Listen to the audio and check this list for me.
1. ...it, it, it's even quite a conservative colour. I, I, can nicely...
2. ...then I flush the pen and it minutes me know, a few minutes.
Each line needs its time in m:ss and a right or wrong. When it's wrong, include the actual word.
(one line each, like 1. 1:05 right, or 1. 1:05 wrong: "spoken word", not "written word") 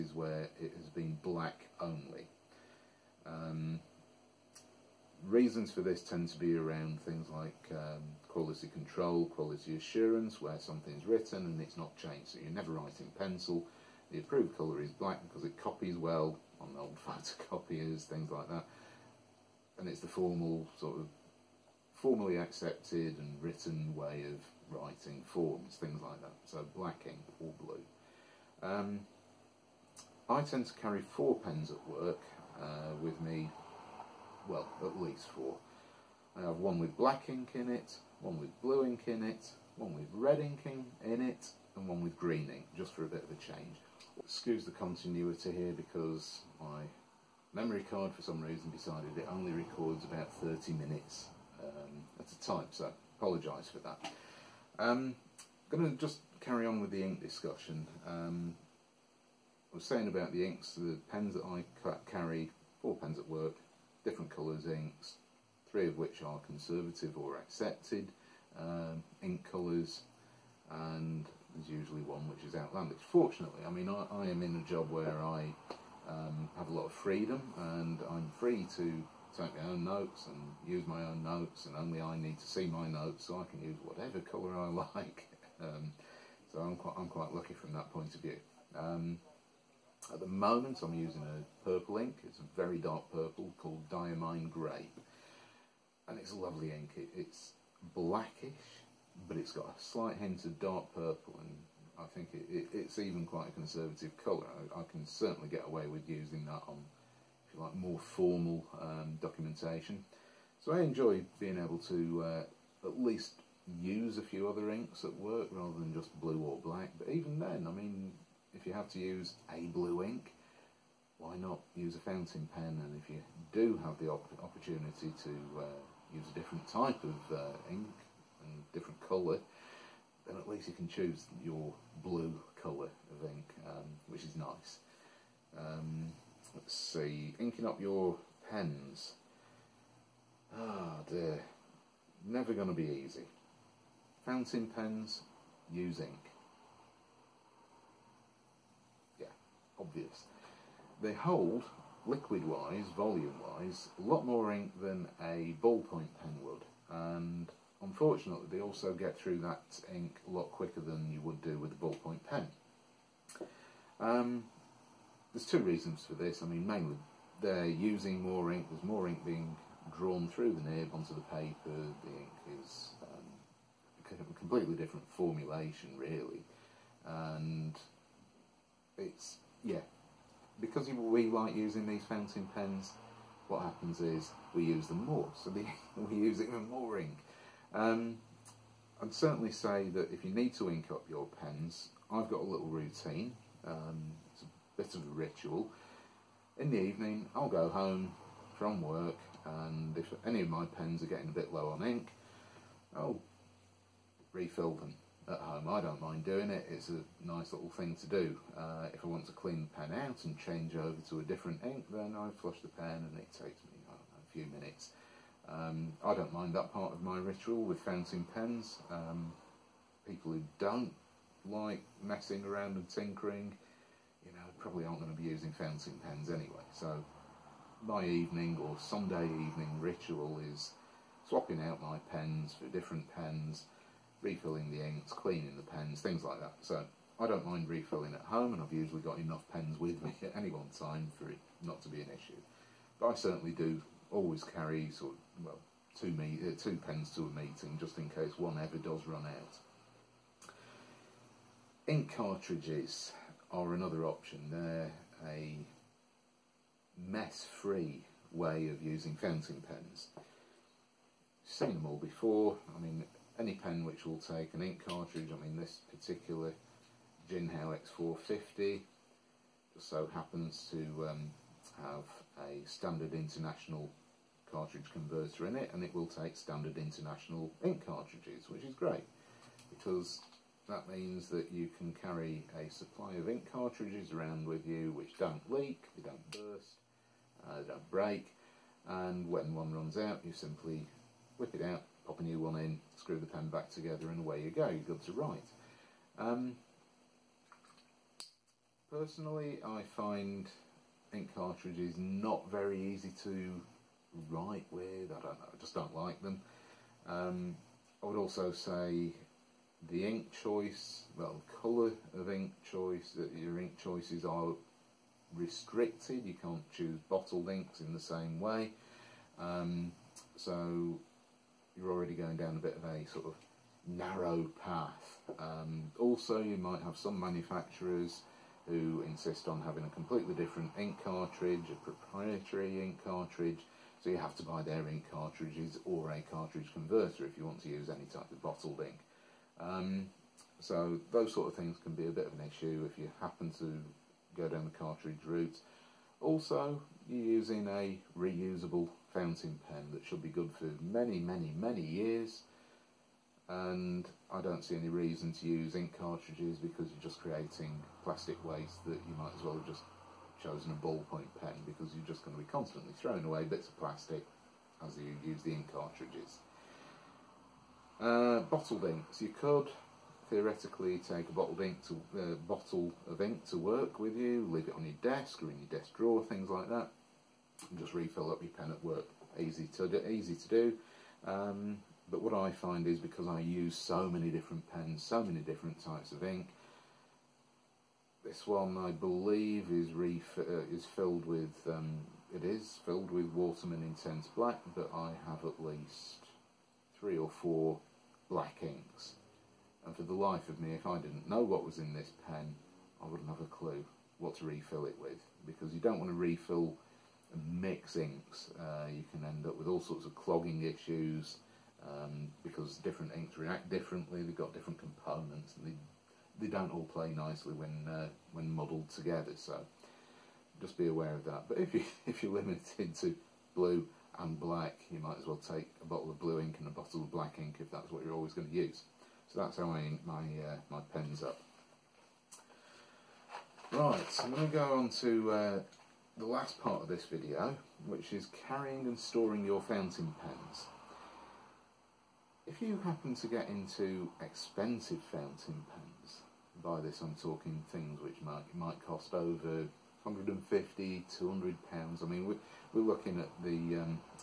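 1. 1:42 wrong: "certainly", not "nicely"
2. 3:31 wrong: "takes", not "minutes".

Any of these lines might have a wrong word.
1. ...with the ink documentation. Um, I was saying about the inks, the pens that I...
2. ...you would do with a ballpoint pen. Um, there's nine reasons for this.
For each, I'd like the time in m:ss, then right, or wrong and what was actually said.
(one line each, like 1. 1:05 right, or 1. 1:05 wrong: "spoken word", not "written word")
1. 0:56 wrong: "discussion", not "documentation"
2. 2:41 wrong: "two", not "nine".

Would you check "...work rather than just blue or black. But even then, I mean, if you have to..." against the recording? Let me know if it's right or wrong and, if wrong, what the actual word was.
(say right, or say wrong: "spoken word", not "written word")
right.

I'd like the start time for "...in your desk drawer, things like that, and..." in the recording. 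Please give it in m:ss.
6:15.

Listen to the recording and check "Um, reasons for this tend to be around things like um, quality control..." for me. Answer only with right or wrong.
right.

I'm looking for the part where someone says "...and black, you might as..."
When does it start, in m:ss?
7:04.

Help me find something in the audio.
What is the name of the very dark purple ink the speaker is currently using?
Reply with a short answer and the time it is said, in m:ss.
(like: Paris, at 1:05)
Diamine grey, at 1:33.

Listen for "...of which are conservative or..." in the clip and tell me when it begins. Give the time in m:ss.
1:05.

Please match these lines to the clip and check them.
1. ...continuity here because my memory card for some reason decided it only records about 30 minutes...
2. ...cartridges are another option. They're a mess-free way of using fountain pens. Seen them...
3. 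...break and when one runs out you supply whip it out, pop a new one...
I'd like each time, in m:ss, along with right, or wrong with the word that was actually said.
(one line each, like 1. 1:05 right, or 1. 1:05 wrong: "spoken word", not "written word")
1. 0:44 right
2. 4:12 right
3. 4:47 wrong: "simply", not "supply".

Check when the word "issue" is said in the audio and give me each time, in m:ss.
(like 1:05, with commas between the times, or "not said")
4:02, 5:42, 6:50.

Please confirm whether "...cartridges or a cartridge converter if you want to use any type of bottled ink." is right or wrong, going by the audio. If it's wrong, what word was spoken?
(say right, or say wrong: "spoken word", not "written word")
right.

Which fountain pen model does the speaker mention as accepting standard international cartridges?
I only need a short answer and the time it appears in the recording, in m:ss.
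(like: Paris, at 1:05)
Jinhao X450, at 4:27.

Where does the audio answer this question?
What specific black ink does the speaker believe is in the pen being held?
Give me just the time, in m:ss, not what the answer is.
6:33.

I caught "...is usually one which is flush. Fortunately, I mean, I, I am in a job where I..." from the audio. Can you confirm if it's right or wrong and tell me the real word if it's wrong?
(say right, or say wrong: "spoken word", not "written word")
wrong: "outlandish", not "flush".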